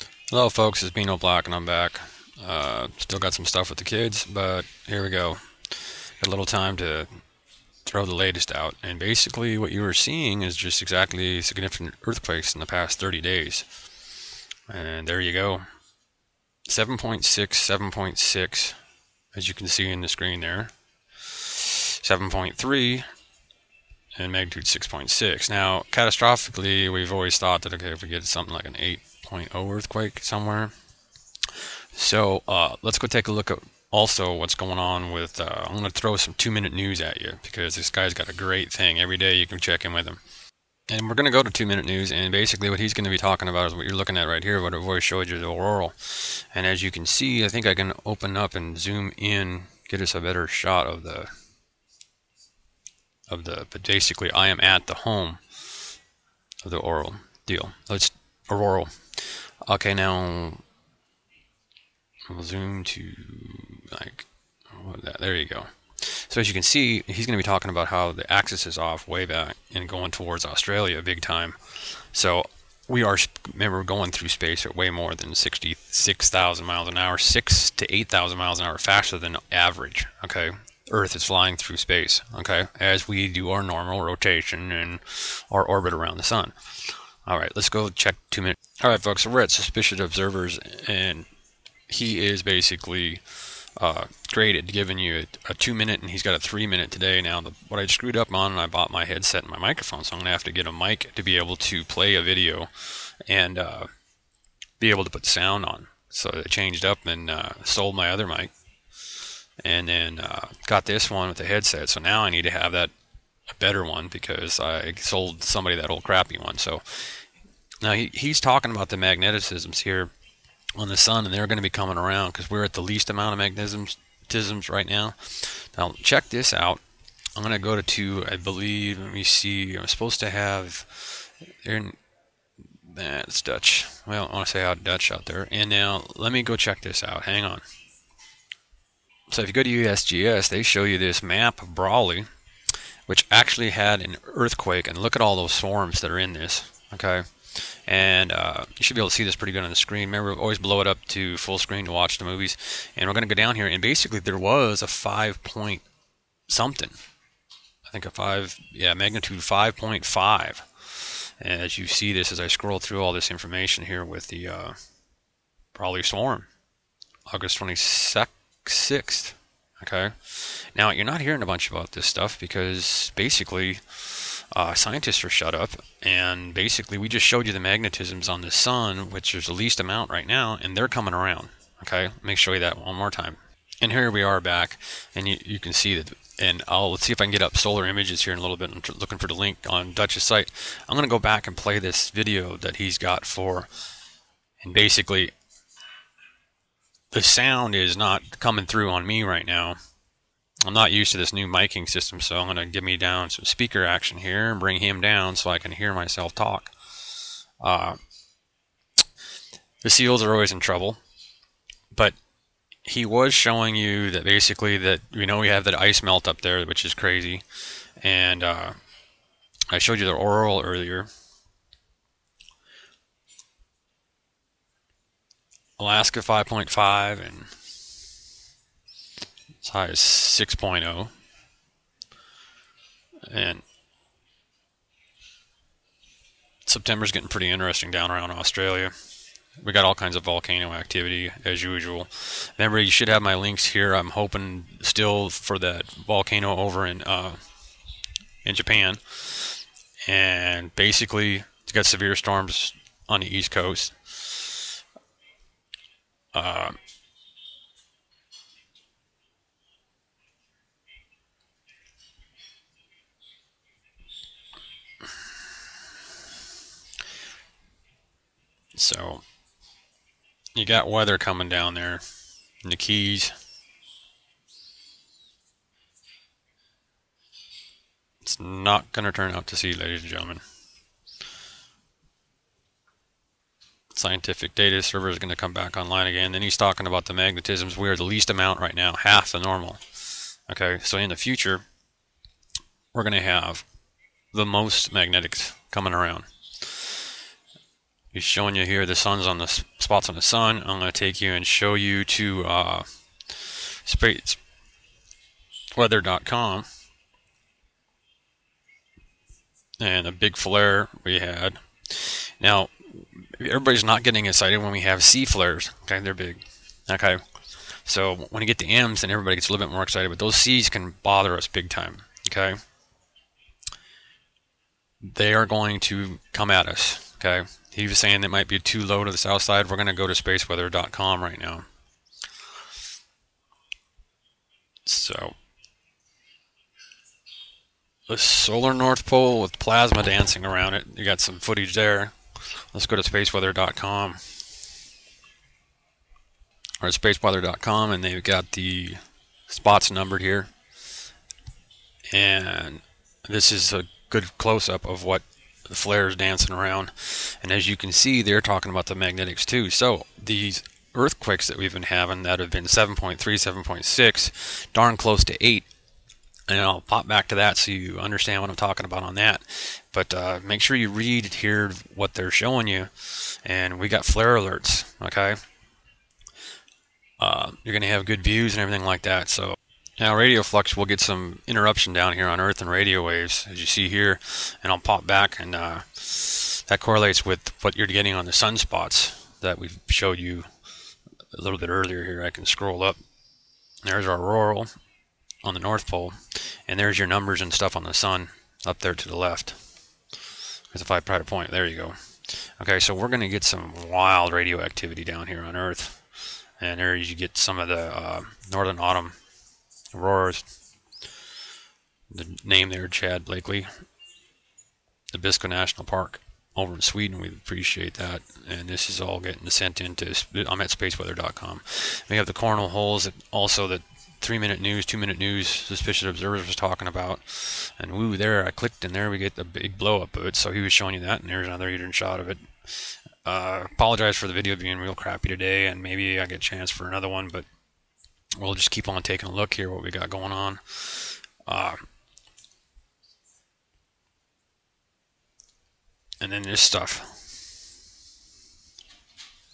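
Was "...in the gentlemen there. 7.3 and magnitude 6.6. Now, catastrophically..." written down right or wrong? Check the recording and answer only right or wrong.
wrong.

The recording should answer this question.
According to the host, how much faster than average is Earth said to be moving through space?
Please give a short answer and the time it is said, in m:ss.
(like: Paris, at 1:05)
6 to 8,000 miles an hour, at 1:17.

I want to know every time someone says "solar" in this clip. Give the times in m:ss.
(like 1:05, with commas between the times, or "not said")
3:07, 5:38.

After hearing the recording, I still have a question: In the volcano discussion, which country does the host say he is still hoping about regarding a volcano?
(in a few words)
Japan.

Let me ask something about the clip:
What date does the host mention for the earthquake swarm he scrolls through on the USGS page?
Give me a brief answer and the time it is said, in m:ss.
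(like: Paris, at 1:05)
August 26th, at 2:47.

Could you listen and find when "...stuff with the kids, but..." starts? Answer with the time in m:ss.
0:03.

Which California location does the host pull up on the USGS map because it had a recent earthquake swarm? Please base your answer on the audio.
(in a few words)
Brawley.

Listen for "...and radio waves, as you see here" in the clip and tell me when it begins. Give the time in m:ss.
6:22.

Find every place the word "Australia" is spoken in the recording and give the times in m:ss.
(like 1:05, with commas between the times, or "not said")
1:10, 3:58.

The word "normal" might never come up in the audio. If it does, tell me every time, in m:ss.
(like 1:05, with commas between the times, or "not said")
1:23, 4:49.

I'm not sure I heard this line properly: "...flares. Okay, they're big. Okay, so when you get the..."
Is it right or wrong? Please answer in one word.
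right.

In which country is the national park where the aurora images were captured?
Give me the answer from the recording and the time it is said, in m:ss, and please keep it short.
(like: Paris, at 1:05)
Sweden, at 6:56.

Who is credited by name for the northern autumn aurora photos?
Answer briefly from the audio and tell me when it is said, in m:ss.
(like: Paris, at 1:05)
Chad Blakley, at 6:52.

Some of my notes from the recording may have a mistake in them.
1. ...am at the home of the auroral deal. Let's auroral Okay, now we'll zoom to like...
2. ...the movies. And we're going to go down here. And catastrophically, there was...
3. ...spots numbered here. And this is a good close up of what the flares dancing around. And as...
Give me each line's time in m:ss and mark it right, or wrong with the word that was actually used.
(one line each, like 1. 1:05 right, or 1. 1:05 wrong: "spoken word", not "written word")
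1. 0:54 right
2. 2:32 wrong: "basically", not "catastrophically"
3. 5:49 right.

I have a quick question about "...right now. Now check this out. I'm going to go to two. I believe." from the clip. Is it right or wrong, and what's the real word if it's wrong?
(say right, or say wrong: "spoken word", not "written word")
right.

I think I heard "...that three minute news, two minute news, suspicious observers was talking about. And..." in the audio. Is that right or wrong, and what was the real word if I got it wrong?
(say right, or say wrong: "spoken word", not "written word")
right.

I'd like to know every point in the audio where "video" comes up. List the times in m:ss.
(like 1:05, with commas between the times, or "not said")
1:42, 3:12, 7:14.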